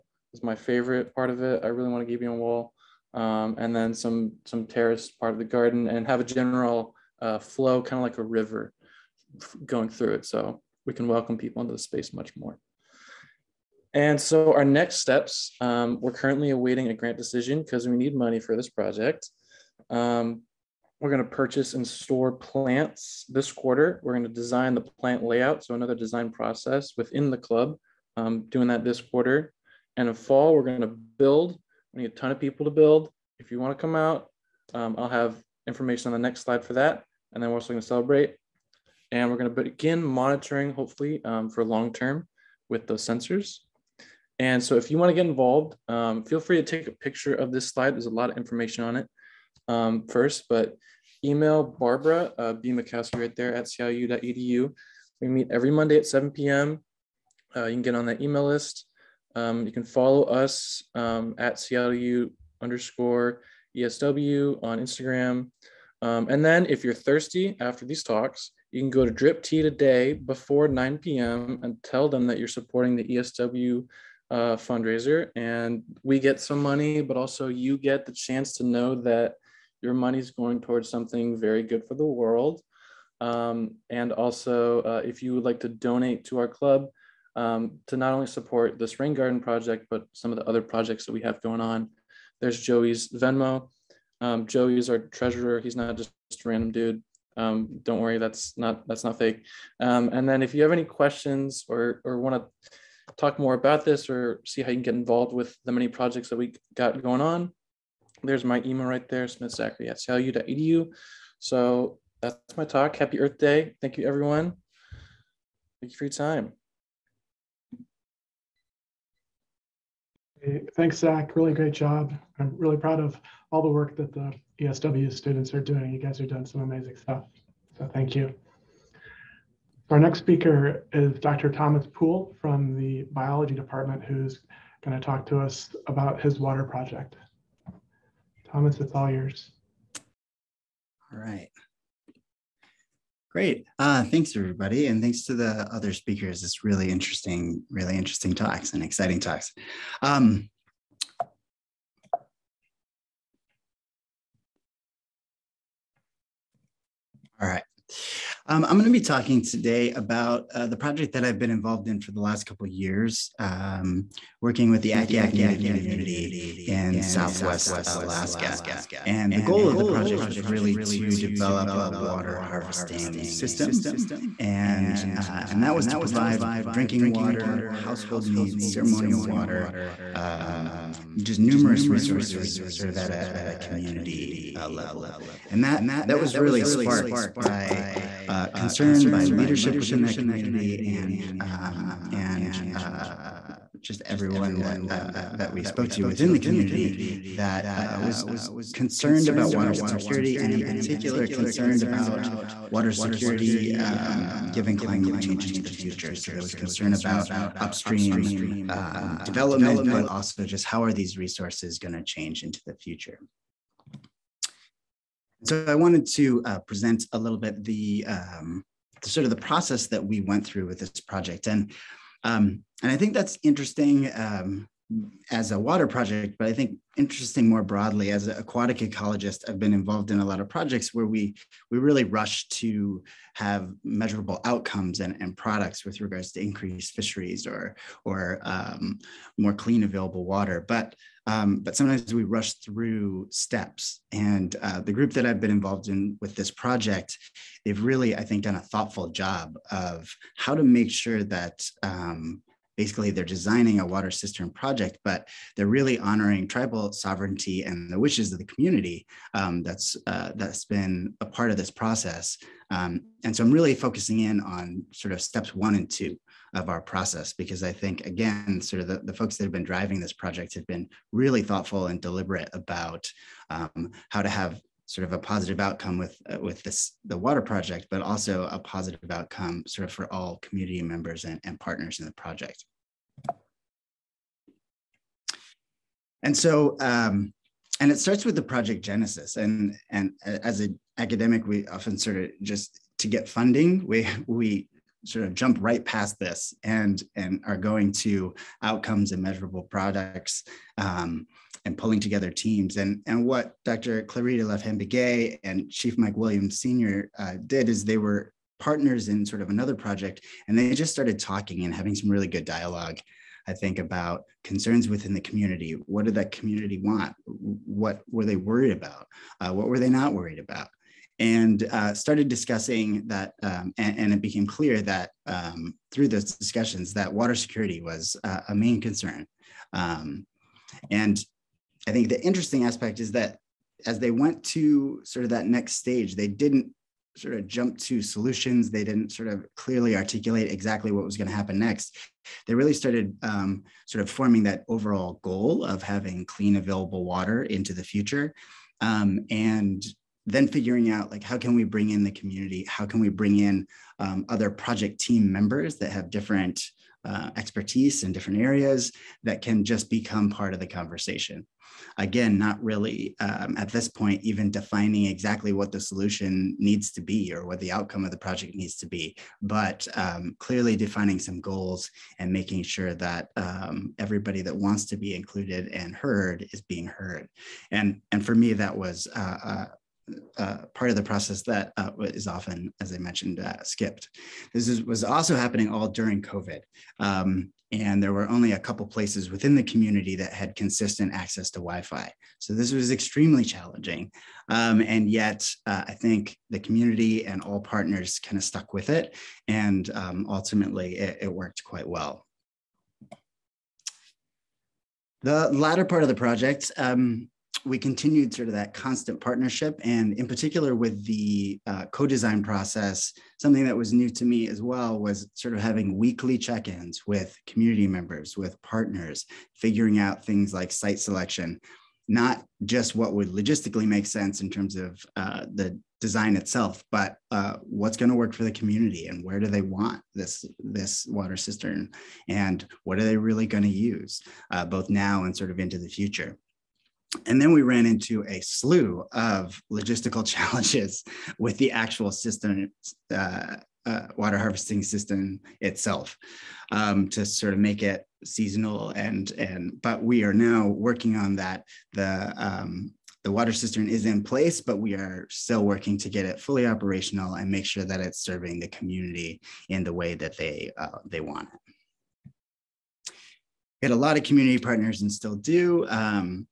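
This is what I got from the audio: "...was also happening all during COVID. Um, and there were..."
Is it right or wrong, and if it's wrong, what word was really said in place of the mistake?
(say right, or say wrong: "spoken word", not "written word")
right.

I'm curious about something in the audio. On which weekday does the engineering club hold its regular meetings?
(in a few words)
Monday.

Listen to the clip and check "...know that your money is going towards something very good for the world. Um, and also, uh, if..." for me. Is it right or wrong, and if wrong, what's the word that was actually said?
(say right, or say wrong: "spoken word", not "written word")
right.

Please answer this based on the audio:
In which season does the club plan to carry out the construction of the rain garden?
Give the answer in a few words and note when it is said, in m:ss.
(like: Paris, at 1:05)
Fall, at 0:30.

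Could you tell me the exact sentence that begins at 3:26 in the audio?
So there was concern about upstream um, development, but also just how are these resources going to change into the future.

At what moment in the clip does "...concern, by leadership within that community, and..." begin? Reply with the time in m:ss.
3:08.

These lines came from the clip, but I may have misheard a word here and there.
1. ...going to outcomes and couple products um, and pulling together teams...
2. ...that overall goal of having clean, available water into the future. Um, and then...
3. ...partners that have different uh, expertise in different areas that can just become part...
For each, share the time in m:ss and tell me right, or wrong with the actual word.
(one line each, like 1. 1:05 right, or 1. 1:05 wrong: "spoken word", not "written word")
1. 4:57 wrong: "measurable", not "couple"
2. 5:44 right
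3. 5:55 wrong: "members", not "partners".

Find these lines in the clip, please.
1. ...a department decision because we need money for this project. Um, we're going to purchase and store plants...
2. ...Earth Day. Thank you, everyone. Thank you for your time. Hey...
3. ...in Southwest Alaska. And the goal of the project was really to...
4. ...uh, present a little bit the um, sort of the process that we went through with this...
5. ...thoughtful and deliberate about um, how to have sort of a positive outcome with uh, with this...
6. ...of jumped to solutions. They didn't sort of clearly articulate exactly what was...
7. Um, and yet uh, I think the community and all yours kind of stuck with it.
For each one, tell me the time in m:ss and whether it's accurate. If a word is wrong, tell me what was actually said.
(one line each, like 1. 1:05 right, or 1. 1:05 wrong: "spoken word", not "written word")
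1. 0:16 wrong: "grant", not "department"
2. 1:53 right
3. 2:46 right
4. 3:36 right
5. 4:31 right
6. 5:37 right
7. 6:34 wrong: "partners", not "yours".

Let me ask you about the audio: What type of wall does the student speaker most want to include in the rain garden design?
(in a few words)
Gabion wall.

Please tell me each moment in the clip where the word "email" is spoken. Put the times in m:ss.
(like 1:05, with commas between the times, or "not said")
0:51, 0:58, 1:48.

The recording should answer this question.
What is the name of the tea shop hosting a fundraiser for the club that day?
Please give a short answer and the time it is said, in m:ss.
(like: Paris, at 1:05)
Drip Tea, at 1:09.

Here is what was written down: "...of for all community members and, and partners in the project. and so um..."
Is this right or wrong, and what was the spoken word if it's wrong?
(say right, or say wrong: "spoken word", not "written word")
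right.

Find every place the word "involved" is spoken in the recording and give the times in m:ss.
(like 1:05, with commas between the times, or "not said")
0:45, 1:44, 2:41, 3:49, 4:05.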